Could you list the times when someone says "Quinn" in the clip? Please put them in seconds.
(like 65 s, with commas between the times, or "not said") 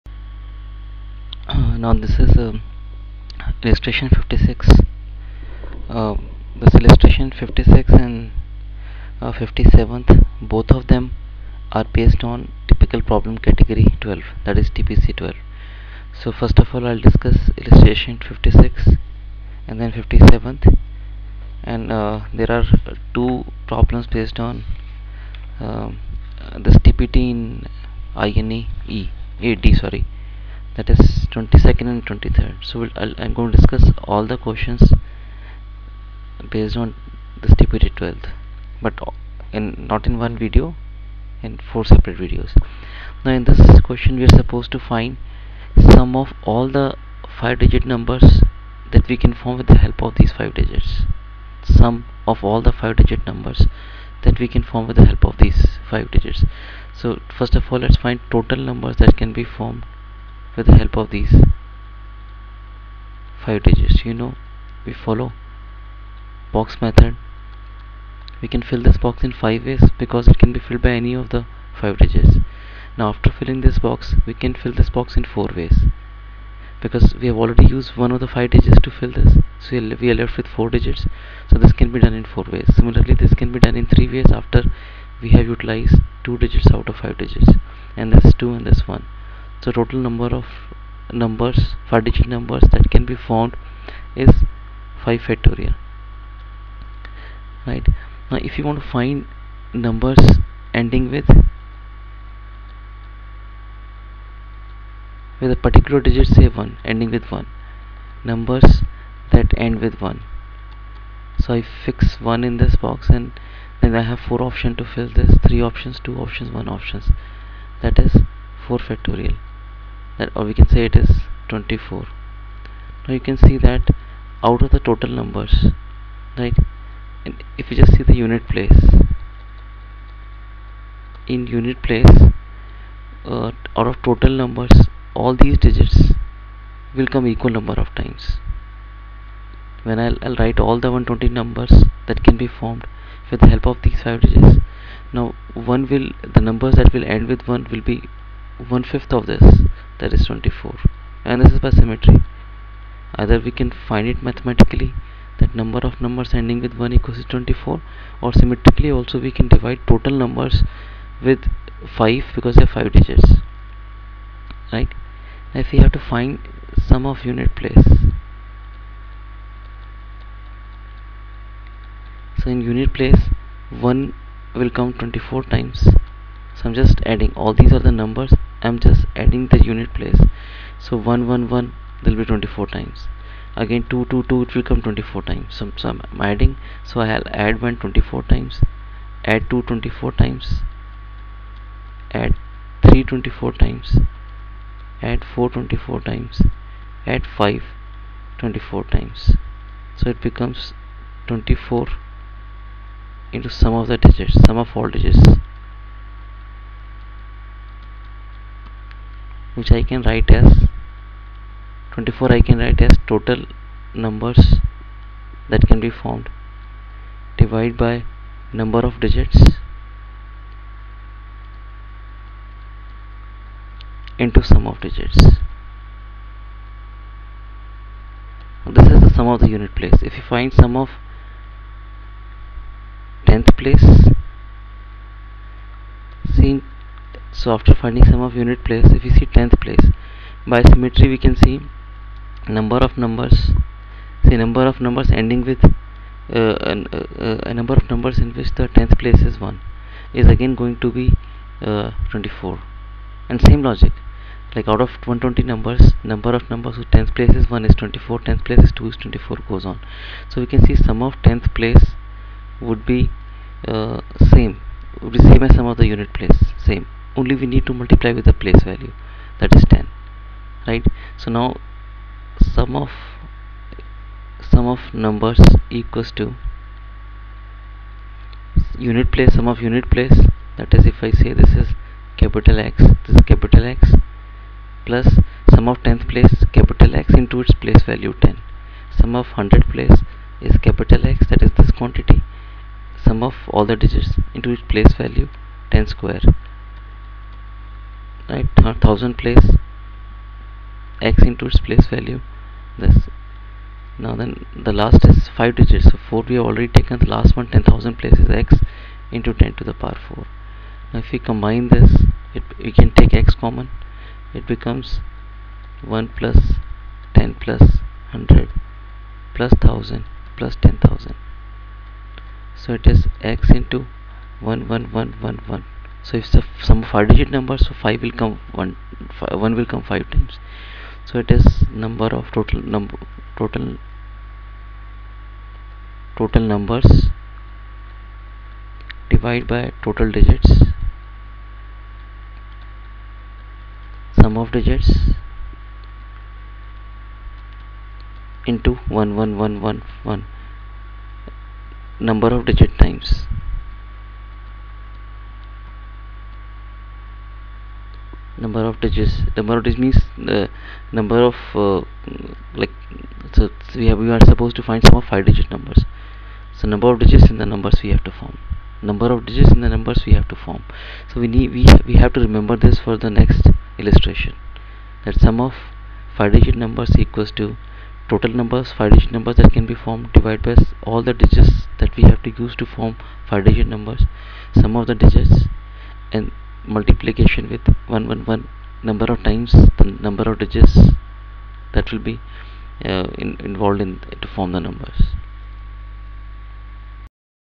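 not said.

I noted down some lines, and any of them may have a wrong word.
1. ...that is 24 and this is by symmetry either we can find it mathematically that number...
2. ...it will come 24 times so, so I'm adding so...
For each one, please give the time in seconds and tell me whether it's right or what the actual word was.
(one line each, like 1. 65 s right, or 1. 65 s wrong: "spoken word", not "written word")
1. 150 s right
2. 184 s right.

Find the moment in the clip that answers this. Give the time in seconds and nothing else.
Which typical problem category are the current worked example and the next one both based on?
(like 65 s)
14 s.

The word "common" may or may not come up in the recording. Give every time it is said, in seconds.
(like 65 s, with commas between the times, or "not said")
313 s.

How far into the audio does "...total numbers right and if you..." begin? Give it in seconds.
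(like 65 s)
124 s.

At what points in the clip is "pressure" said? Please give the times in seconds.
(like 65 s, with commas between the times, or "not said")
not said.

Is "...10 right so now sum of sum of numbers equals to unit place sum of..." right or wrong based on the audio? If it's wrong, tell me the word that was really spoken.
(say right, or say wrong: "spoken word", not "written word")
right.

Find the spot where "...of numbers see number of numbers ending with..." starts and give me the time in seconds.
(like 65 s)
242 s.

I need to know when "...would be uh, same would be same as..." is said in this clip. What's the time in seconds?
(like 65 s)
262 s.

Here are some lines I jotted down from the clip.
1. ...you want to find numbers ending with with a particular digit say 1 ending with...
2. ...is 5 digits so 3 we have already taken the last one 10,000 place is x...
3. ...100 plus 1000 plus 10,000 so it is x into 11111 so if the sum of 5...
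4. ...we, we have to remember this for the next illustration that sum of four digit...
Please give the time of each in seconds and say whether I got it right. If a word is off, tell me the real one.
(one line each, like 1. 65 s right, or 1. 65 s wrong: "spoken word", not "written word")
1. 98 s right
2. 305 s wrong: "4", not "3"
3. 318 s right
4. 371 s wrong: "five", not "four".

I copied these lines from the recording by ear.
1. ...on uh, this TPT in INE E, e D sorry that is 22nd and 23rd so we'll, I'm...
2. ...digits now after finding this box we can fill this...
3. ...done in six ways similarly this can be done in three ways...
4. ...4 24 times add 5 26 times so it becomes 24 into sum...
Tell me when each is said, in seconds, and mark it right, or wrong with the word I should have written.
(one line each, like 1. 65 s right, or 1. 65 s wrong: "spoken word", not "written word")
1. 24 s right
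2. 71 s wrong: "filling", not "finding"
3. 81 s wrong: "four", not "six"
4. 195 s wrong: "24", not "26".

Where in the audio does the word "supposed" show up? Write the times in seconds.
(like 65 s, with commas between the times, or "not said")
44 s, 364 s.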